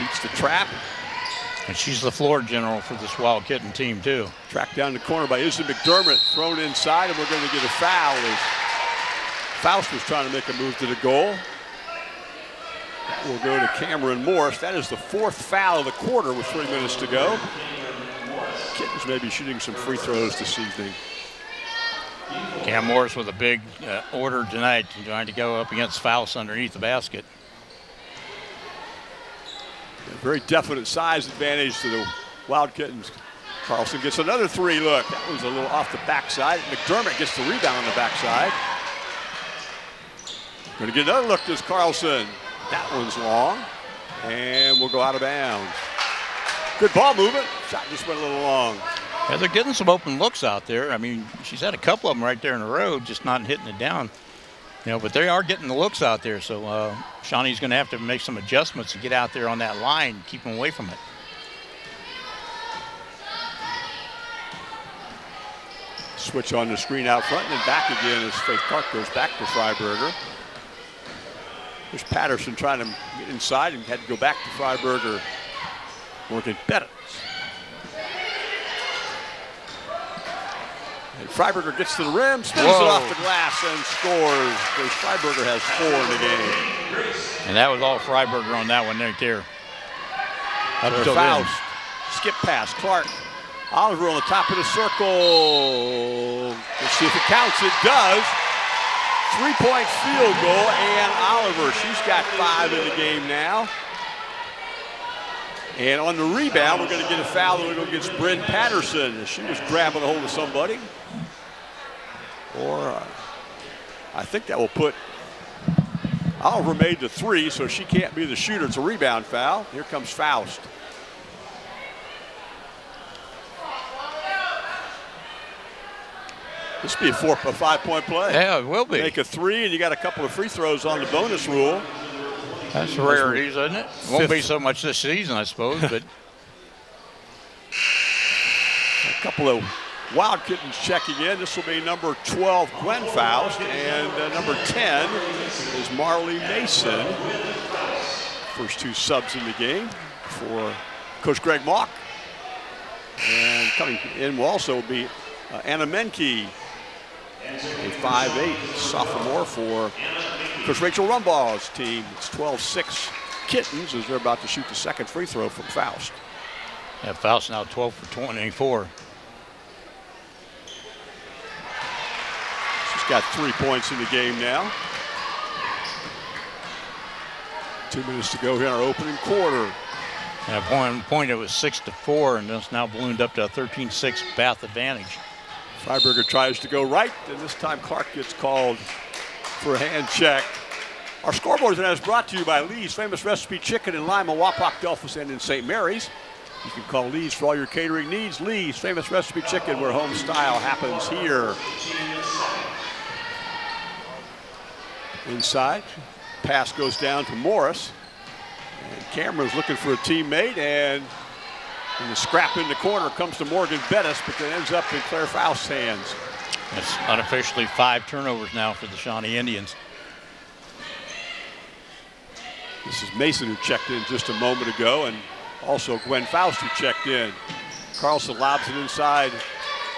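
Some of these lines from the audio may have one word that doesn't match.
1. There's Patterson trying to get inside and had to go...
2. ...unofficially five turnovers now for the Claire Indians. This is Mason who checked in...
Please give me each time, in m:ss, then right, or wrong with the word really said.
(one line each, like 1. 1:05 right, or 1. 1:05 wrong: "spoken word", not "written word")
1. 1:11 right
2. 3:37 wrong: "Shawnee", not "Claire".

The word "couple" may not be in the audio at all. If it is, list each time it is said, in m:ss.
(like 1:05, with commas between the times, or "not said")
0:51, 2:09, 2:19.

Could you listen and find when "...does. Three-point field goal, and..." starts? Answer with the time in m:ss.
1:37.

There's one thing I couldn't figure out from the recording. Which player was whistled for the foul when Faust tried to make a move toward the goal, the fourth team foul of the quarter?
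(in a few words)
Cameron Morris.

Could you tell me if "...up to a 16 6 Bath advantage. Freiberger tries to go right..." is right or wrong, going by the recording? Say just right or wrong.
wrong.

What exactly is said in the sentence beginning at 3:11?
Our scoreboard is brought to you by Lee's Famous Recipe Chicken in Lima, Wapak, Delphos, and in St.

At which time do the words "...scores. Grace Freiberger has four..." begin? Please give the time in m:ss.
1:23.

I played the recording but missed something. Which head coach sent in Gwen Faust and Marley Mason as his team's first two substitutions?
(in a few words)
Greg Mock.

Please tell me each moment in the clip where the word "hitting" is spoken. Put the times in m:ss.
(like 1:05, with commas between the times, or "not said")
0:53.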